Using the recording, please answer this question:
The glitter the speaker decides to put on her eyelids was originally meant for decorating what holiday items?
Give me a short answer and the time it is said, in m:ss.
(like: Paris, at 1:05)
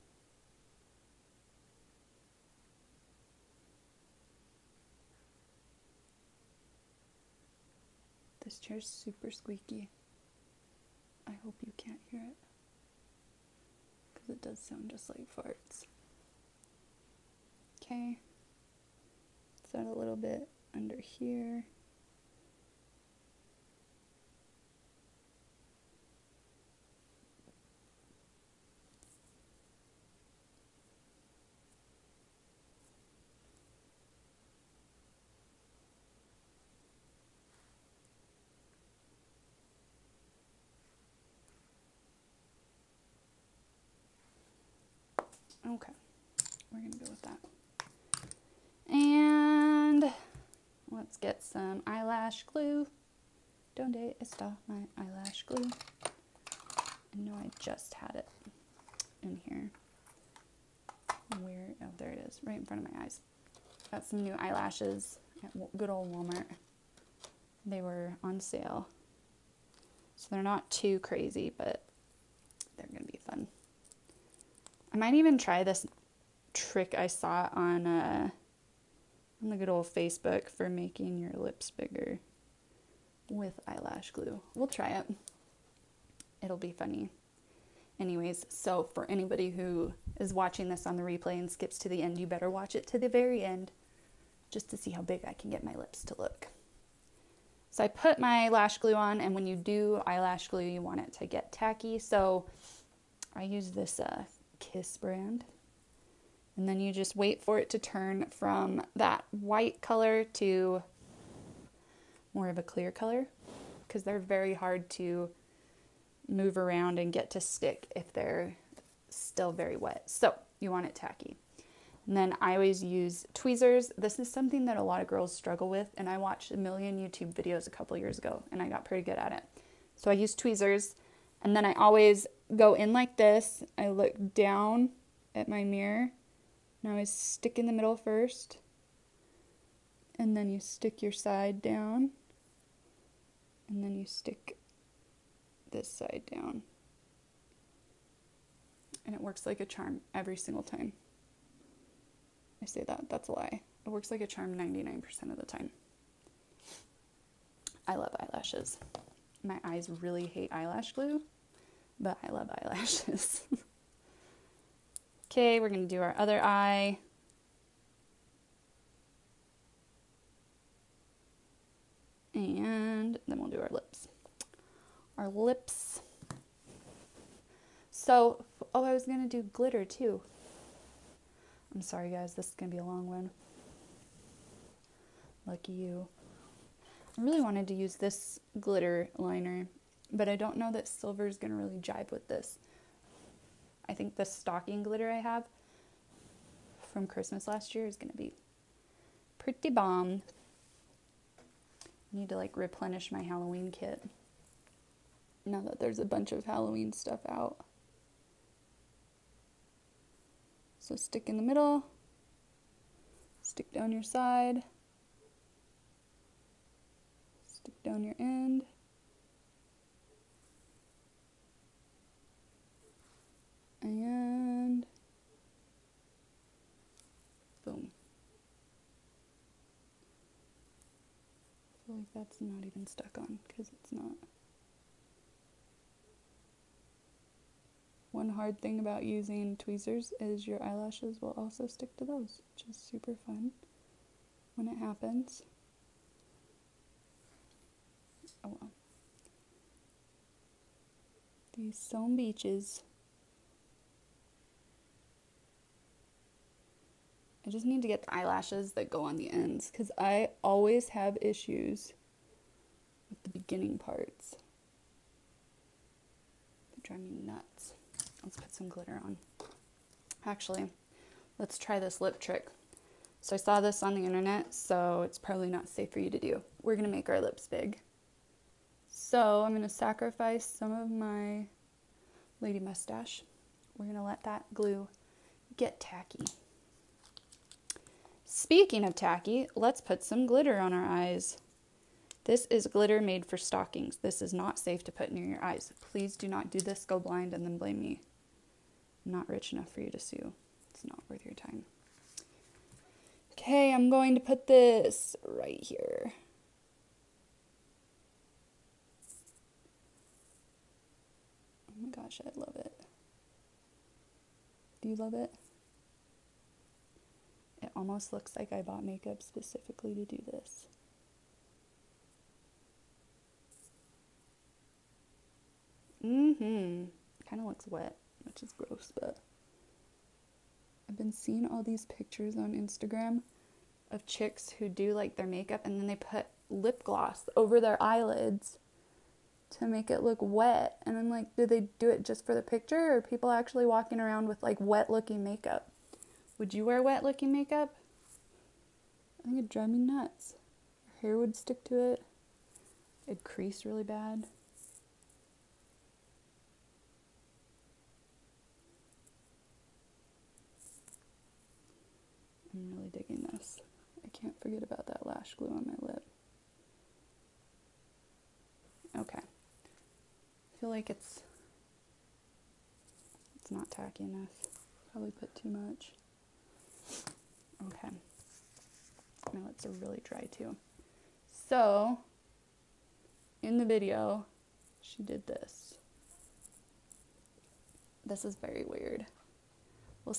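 Stockings, at 4:53.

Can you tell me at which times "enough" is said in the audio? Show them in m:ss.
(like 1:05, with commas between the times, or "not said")
4:59, 6:14.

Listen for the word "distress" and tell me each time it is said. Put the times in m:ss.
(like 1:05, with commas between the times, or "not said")
not said.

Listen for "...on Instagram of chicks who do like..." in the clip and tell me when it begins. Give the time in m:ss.
5:32.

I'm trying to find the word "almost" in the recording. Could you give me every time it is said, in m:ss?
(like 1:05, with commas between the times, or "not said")
5:17.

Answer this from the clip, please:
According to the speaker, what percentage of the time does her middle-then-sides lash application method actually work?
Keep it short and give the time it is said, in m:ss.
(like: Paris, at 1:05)
99%, at 2:34.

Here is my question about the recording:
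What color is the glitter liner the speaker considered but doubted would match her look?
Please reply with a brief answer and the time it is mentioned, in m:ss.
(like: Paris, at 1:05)
Silver, at 3:10.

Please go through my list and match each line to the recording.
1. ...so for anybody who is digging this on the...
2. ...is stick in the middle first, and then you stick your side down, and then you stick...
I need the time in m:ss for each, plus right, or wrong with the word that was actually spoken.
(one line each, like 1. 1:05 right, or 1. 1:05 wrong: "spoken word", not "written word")
1. 1:28 wrong: "watching", not "digging"
2. 2:16 right.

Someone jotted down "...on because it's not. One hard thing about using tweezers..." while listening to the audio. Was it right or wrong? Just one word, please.
right.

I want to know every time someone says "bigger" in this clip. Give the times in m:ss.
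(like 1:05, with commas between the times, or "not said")
1:21.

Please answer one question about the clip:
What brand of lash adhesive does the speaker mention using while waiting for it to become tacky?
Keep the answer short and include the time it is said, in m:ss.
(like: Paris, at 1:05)
Kiss, at 1:44.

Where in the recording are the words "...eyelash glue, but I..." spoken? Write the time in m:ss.
2:40.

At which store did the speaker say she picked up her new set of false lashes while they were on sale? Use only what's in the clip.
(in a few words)
Walmart.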